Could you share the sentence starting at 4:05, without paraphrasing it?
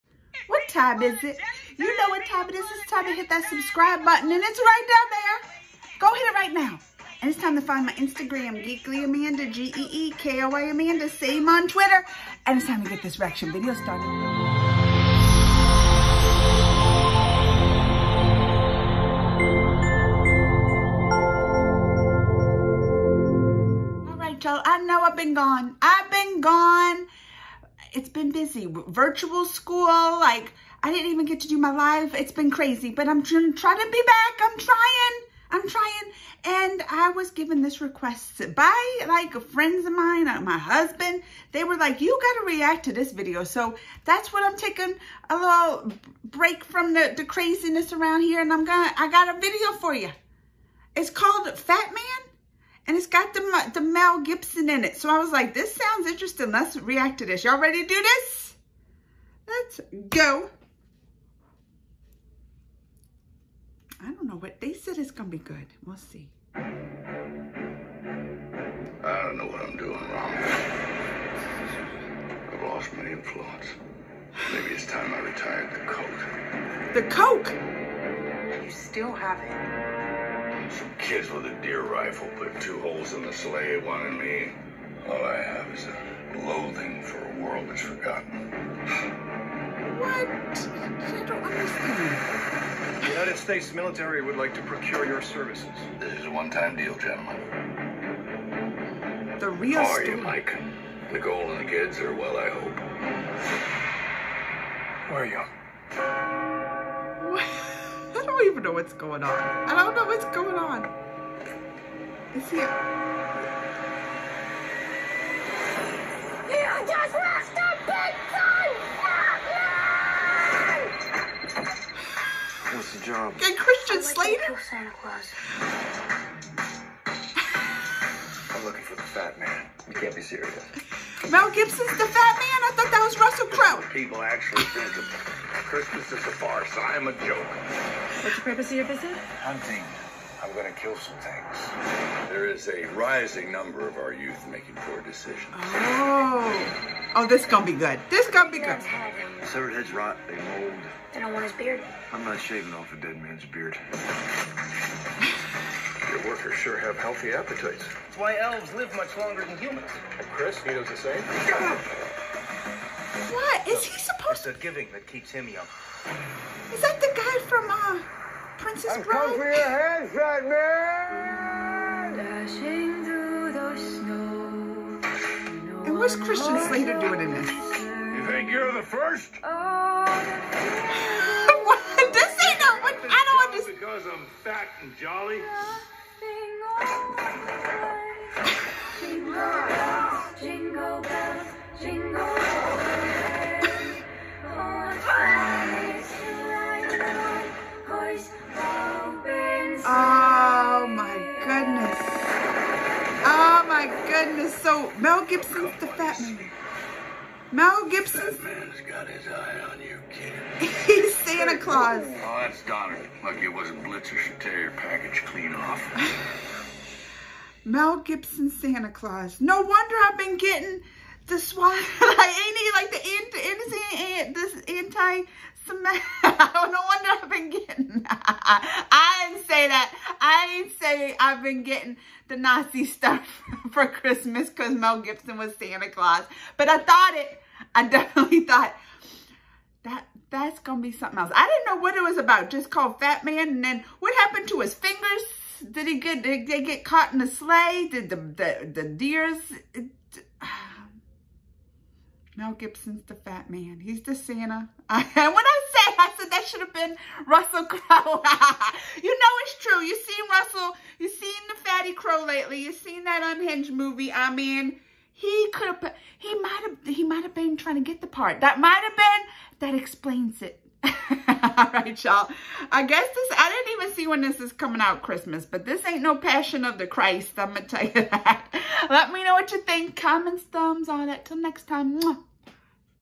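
Did he get, did they get caught in the sleigh?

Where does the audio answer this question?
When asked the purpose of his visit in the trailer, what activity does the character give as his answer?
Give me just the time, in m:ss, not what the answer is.
2:19.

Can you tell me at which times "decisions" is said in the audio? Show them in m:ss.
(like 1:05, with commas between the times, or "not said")
2:25.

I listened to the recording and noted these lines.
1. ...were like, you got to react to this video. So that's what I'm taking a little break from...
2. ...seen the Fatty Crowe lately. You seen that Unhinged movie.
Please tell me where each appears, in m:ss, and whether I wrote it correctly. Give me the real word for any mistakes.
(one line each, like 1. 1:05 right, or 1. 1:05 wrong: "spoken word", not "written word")
1. 0:41 right
2. 4:21 right.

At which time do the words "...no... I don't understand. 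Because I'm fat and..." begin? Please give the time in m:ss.
3:02.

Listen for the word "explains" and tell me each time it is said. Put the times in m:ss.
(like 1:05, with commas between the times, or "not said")
4:29.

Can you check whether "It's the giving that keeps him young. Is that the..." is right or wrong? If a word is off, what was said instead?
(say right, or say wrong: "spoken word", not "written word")
right.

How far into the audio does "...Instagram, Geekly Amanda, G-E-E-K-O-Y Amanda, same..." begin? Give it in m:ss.
0:07.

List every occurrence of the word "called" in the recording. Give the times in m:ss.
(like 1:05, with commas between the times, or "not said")
0:51, 4:02.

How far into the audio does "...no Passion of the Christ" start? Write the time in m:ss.
4:36.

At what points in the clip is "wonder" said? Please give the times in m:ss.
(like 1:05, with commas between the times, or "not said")
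3:39, 3:46.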